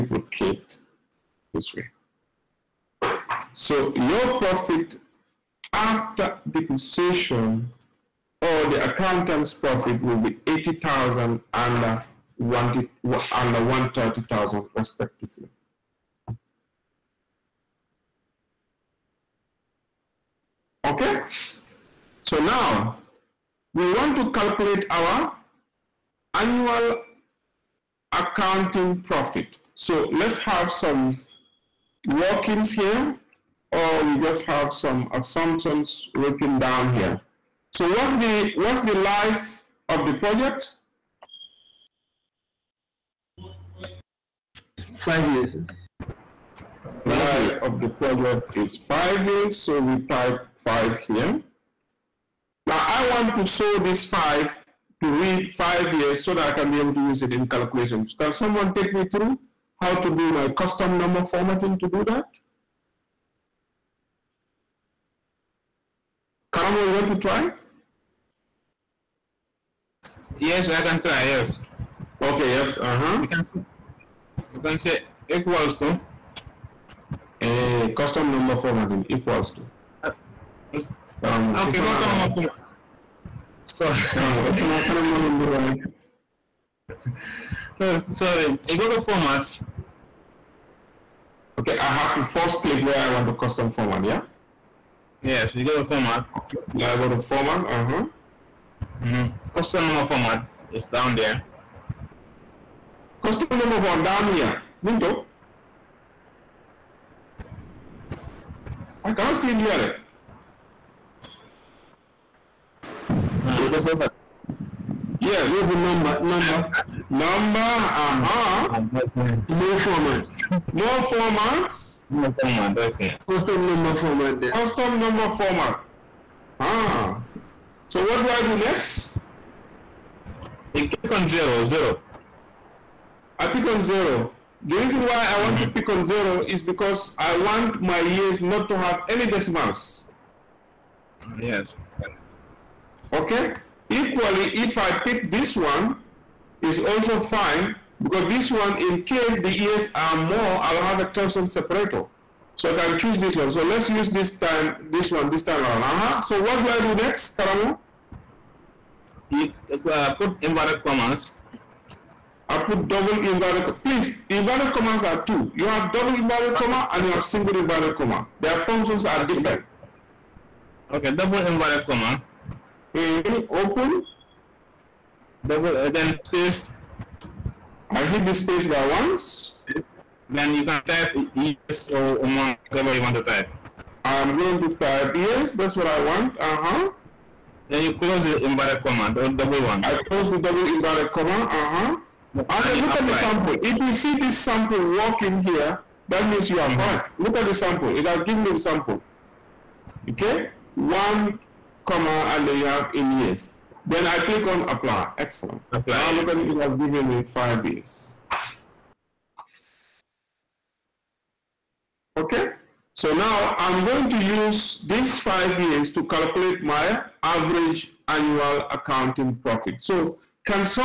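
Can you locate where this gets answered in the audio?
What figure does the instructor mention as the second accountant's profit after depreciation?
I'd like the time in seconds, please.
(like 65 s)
13 s.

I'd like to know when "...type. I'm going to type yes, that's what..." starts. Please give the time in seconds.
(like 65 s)
183 s.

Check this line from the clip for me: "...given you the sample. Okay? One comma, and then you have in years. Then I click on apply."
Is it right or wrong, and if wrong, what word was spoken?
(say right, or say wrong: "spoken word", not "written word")
right.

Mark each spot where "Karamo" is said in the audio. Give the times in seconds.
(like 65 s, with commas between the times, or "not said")
66 s, 80 s, 157 s.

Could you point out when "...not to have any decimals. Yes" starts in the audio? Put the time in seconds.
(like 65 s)
138 s.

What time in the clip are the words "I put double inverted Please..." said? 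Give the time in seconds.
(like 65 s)
162 s.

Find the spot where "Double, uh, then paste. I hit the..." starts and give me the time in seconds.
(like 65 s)
175 s.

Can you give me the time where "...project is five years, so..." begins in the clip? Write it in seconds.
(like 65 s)
47 s.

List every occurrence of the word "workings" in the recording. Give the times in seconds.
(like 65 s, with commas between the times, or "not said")
32 s, 194 s.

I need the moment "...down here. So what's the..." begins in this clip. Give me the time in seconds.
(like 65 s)
36 s.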